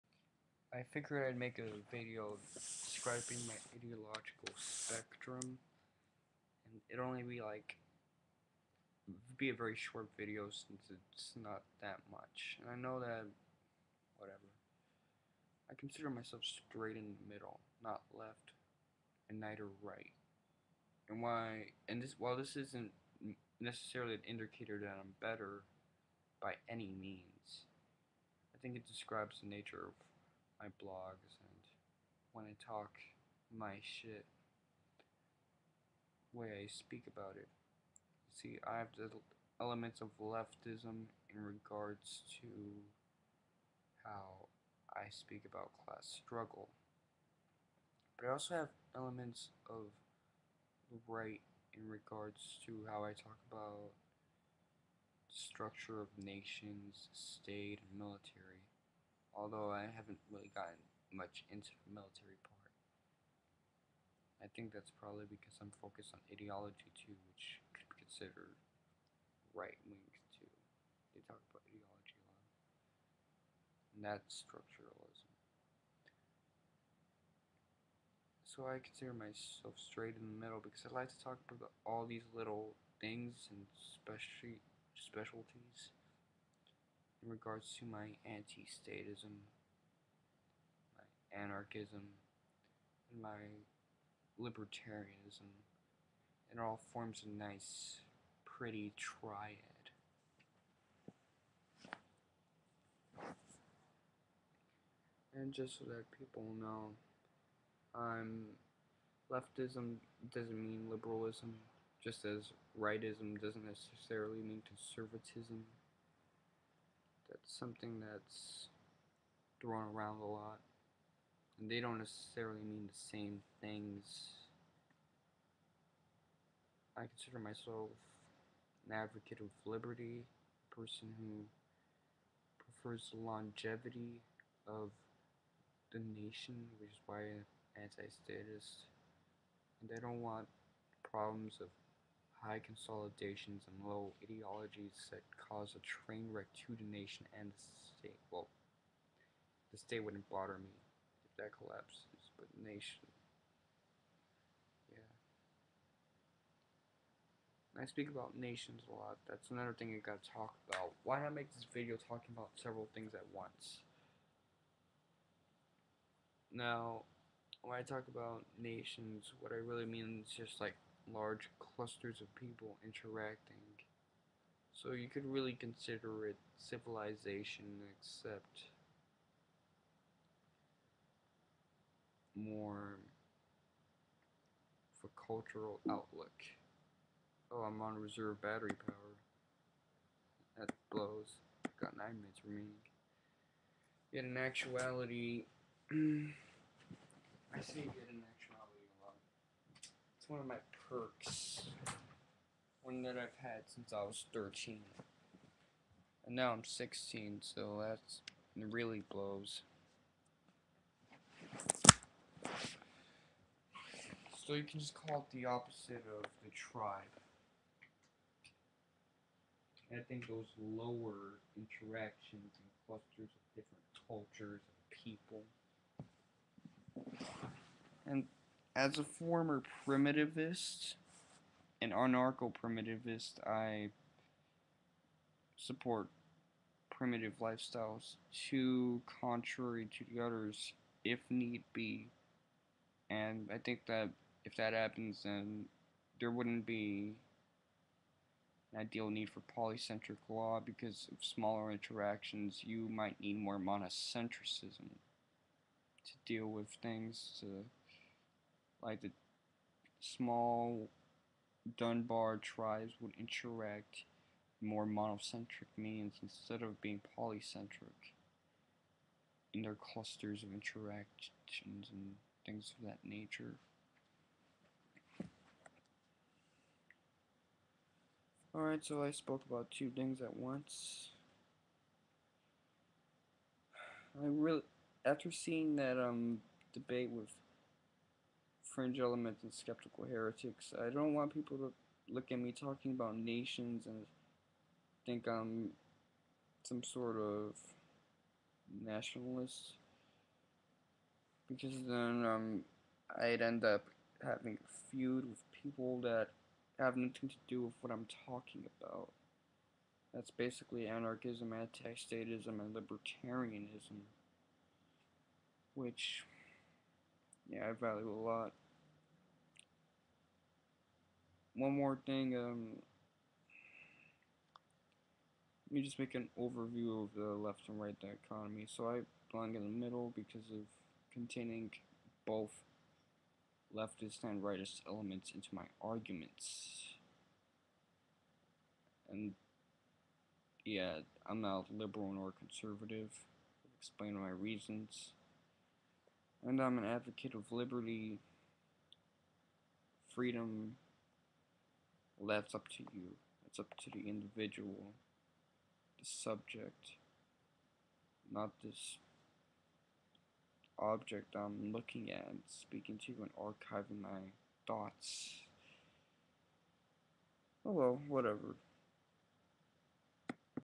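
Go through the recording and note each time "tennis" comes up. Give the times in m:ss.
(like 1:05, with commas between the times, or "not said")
not said.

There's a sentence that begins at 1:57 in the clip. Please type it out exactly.
That's something that's thrown around a lot.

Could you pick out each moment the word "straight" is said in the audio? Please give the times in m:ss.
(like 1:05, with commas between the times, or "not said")
0:16, 1:19.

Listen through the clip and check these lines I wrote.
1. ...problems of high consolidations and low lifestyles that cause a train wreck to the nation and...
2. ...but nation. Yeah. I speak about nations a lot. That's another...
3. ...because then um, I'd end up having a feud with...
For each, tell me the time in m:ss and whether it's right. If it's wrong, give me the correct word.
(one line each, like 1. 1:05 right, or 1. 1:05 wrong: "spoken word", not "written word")
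1. 2:21 wrong: "ideologies", not "lifestyles"
2. 2:32 right
3. 5:01 right.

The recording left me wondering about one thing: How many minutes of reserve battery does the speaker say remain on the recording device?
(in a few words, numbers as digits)
9.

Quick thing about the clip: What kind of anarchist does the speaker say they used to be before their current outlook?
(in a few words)
anarcho primitivist.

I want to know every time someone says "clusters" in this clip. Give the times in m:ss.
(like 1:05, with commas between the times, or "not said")
2:51, 3:42, 4:29.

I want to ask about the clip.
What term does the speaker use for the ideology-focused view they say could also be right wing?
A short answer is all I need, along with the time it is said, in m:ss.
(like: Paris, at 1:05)
structuralism, at 1:14.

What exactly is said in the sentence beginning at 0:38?
See, I have the elements of leftism in regards to how I speak about class struggle.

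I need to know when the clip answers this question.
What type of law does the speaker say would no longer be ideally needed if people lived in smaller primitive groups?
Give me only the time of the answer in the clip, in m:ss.
4:09.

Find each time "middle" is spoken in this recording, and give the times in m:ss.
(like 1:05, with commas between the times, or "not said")
0:17, 1:20, 5:29.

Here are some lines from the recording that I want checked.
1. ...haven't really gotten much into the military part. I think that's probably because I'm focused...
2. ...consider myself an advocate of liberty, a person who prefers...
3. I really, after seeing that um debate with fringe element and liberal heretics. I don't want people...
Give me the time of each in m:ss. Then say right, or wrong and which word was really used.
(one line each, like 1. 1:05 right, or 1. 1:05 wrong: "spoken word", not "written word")
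1. 0:59 right
2. 2:07 right
3. 4:44 wrong: "skeptical", not "liberal".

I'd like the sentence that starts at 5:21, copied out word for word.
One more thing, um, let me just make an overview of the left and right dichotomy.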